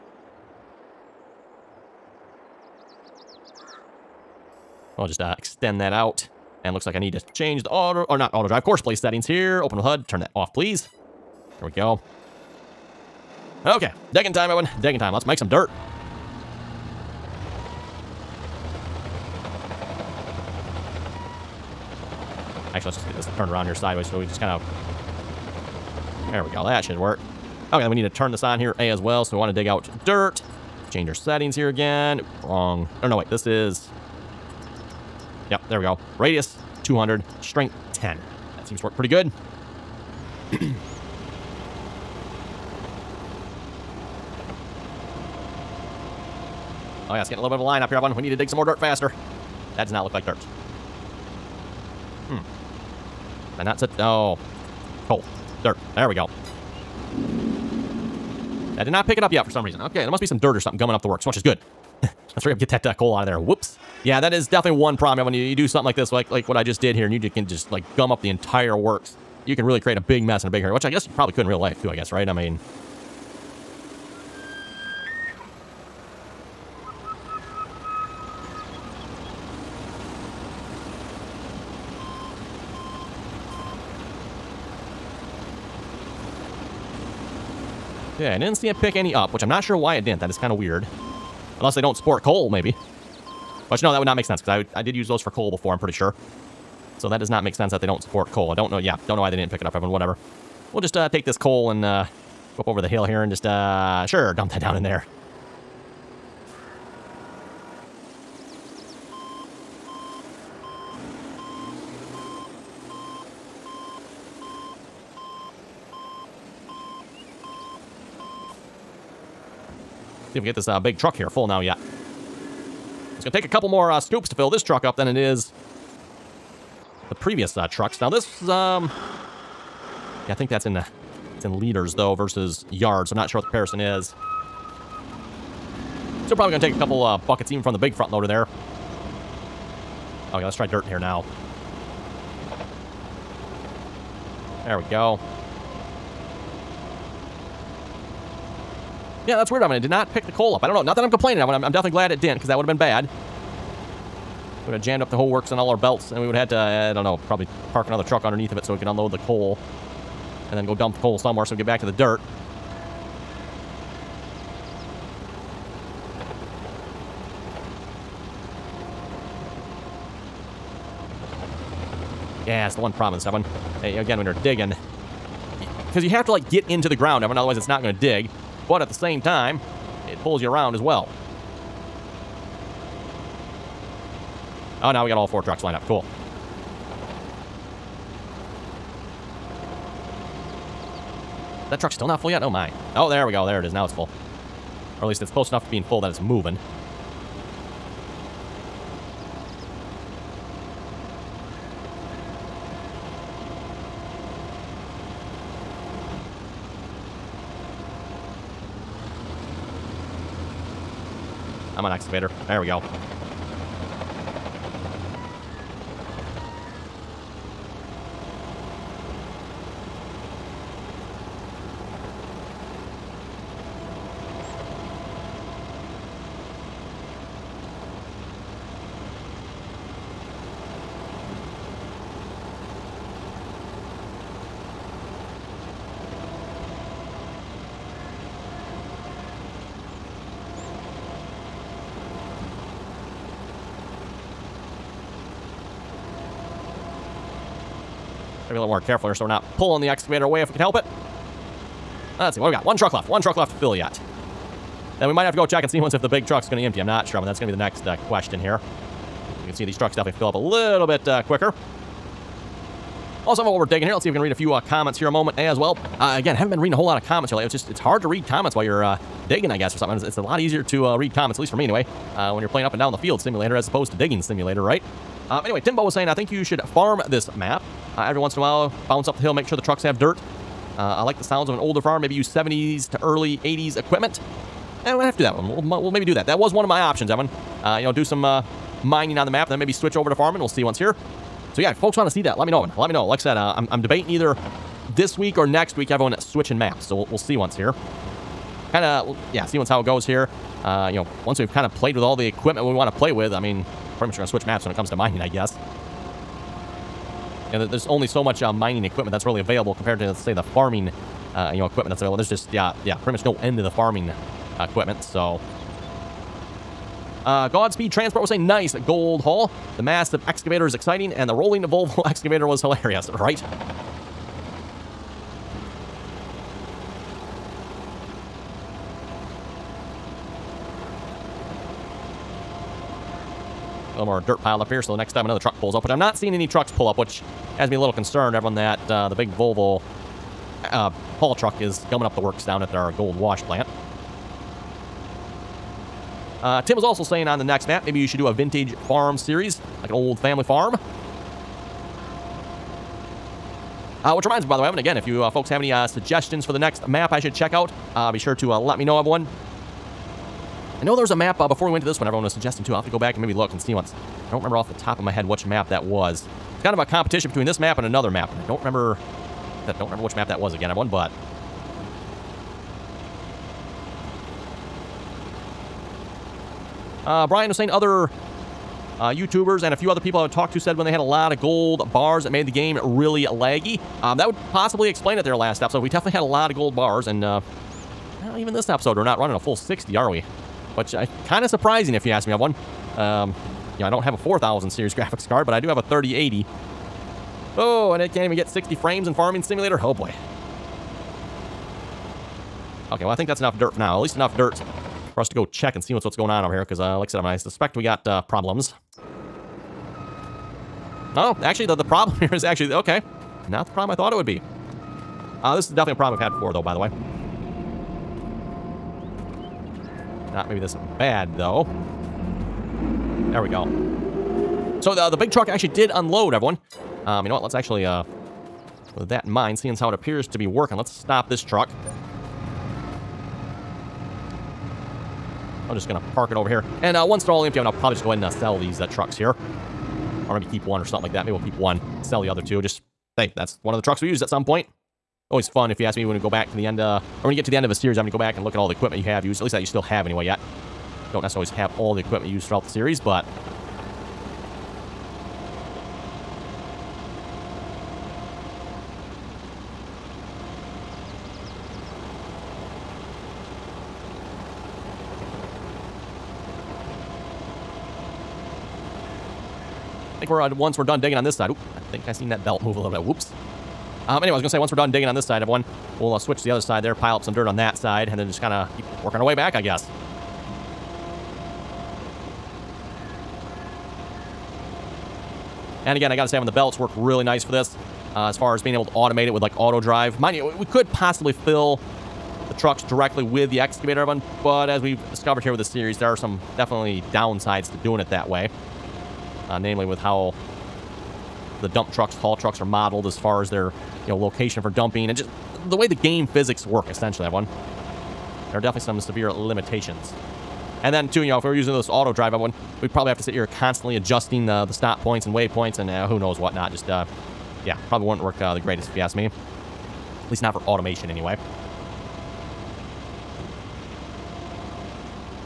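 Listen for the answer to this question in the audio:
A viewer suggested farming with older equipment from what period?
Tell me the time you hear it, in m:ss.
4:42.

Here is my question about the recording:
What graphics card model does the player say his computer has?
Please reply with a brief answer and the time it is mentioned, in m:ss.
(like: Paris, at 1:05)
3080, at 6:35.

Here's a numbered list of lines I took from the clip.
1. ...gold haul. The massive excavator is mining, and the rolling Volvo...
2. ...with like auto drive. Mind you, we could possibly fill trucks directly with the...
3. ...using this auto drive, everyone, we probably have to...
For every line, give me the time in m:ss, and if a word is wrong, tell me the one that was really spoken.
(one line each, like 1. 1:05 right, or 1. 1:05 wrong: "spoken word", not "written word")
1. 5:18 wrong: "exciting", not "mining"
2. 8:09 right
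3. 8:31 right.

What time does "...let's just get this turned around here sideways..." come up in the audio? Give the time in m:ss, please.
0:22.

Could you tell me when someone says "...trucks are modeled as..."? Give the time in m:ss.
8:22.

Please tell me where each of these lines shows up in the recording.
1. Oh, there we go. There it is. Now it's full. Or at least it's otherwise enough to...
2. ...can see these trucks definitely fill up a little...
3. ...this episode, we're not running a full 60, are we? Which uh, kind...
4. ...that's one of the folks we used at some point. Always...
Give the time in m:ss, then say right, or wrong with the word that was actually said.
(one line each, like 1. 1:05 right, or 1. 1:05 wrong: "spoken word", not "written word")
1. 3:12 wrong: "close", not "otherwise"
2. 4:19 right
3. 6:28 right
4. 7:23 wrong: "trucks", not "folks".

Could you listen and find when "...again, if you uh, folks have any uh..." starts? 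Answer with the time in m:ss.
5:54.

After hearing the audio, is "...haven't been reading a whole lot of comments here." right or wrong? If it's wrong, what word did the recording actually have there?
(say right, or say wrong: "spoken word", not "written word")
right.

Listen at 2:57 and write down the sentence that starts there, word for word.
otherwise it's not going to dig.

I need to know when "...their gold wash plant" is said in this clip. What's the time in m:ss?
5:42.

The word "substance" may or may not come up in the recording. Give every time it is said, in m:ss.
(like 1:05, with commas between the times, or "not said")
not said.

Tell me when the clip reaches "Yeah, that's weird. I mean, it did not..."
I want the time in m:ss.
2:29.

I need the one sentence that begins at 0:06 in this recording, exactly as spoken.
And looks like I need to change the auto, or not auto drive, course place settings here.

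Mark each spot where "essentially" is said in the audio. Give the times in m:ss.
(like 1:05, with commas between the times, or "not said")
8:26.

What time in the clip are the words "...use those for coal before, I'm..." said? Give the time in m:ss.
1:34.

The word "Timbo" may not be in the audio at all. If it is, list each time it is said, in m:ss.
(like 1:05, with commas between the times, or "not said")
4:35.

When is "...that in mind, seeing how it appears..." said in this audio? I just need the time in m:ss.
7:09.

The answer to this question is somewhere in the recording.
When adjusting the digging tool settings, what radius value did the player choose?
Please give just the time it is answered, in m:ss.
0:36.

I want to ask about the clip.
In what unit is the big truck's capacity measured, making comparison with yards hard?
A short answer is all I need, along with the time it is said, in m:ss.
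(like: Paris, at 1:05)
liters, at 2:11.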